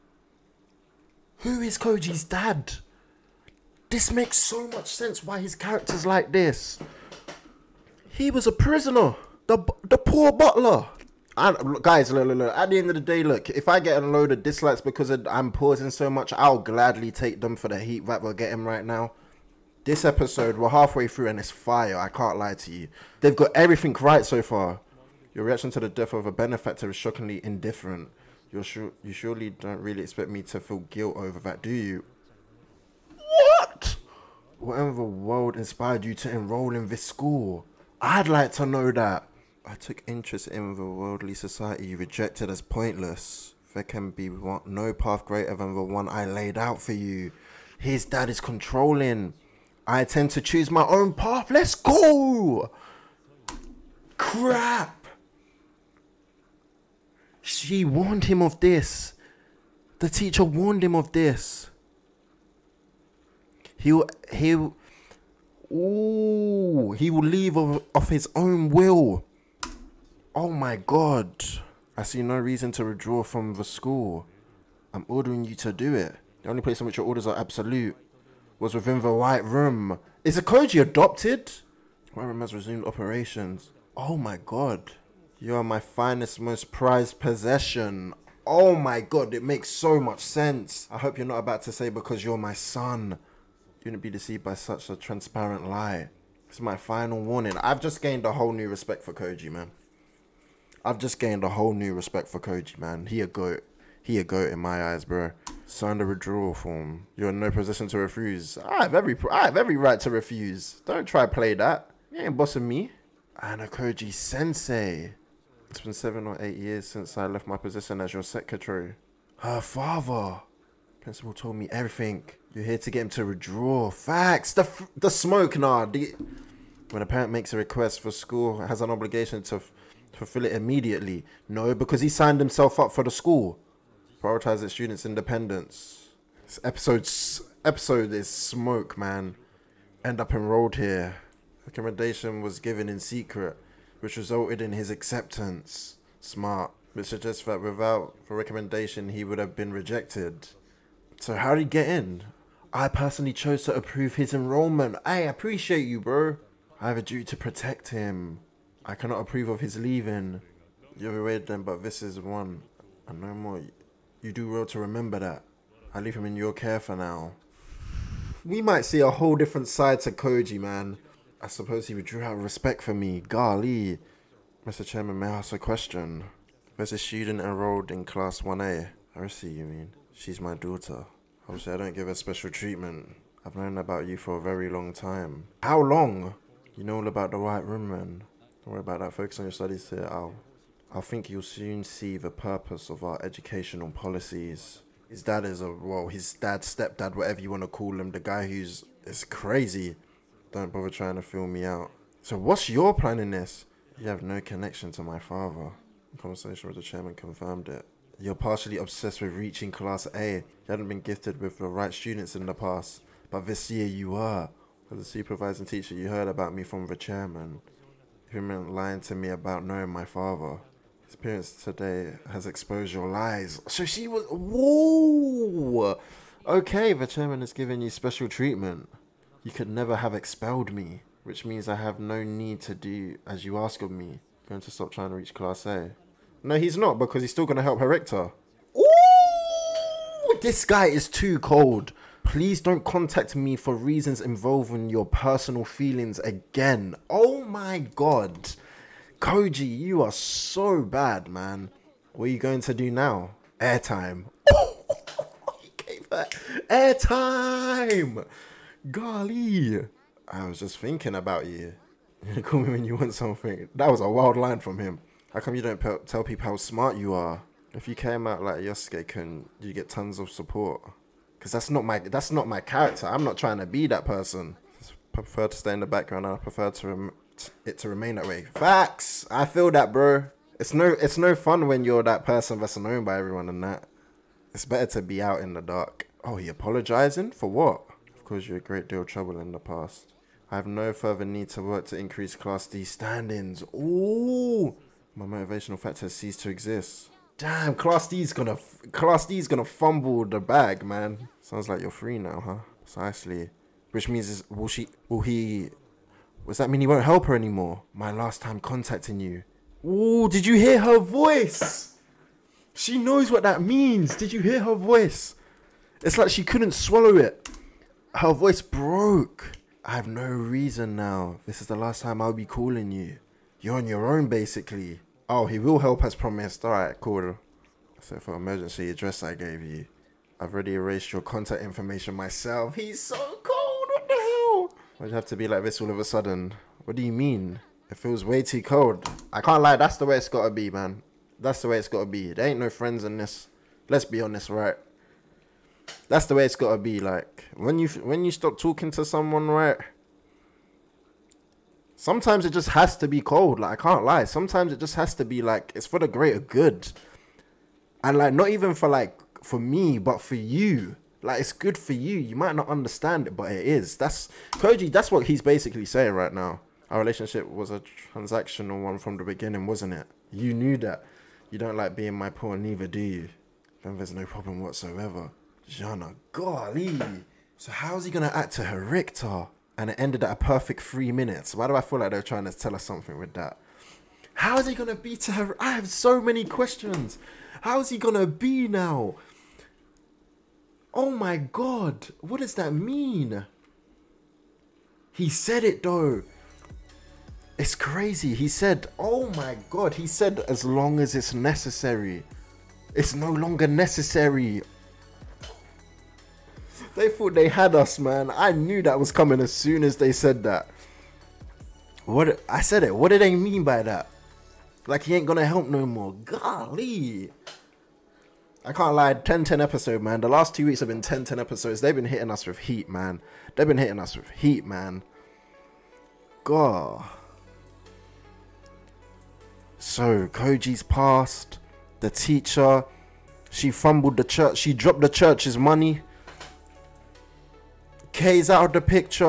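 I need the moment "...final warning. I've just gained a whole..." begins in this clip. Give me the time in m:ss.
1:36.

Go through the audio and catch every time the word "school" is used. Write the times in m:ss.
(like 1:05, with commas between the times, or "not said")
0:37, 1:13, 2:08, 2:13.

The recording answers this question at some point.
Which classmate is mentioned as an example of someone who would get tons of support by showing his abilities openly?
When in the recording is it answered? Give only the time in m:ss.
4:28.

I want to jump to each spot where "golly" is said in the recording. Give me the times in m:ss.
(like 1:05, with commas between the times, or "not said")
2:53, 4:18, 6:16, 6:56.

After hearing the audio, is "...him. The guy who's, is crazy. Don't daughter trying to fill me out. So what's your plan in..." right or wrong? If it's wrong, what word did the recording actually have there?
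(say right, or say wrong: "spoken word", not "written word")
wrong: "bother", not "daughter".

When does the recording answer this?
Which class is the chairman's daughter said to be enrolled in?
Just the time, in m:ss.
2:58.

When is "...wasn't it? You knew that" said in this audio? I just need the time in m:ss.
6:09.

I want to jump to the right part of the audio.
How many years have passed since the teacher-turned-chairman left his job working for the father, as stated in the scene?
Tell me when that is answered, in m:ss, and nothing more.
1:55.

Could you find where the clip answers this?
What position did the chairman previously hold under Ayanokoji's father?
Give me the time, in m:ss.
1:58.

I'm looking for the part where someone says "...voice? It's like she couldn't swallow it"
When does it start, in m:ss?
5:14.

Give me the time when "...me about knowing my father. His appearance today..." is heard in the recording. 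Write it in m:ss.
3:39.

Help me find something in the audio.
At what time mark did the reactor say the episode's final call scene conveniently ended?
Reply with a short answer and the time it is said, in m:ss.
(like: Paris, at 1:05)
3 minutes, at 6:20.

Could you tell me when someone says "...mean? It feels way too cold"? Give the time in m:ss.
5:37.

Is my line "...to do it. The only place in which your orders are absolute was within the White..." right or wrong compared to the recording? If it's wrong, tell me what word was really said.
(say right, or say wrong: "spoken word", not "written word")
right.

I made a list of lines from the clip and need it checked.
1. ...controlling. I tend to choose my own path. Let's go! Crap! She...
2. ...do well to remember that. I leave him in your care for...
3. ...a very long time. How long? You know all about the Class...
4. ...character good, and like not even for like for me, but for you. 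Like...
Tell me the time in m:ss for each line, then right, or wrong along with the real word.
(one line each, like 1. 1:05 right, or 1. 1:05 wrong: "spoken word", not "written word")
1. 0:48 right
2. 2:44 right
3. 3:04 wrong: "White", not "Class"
4. 5:56 wrong: "greater", not "character".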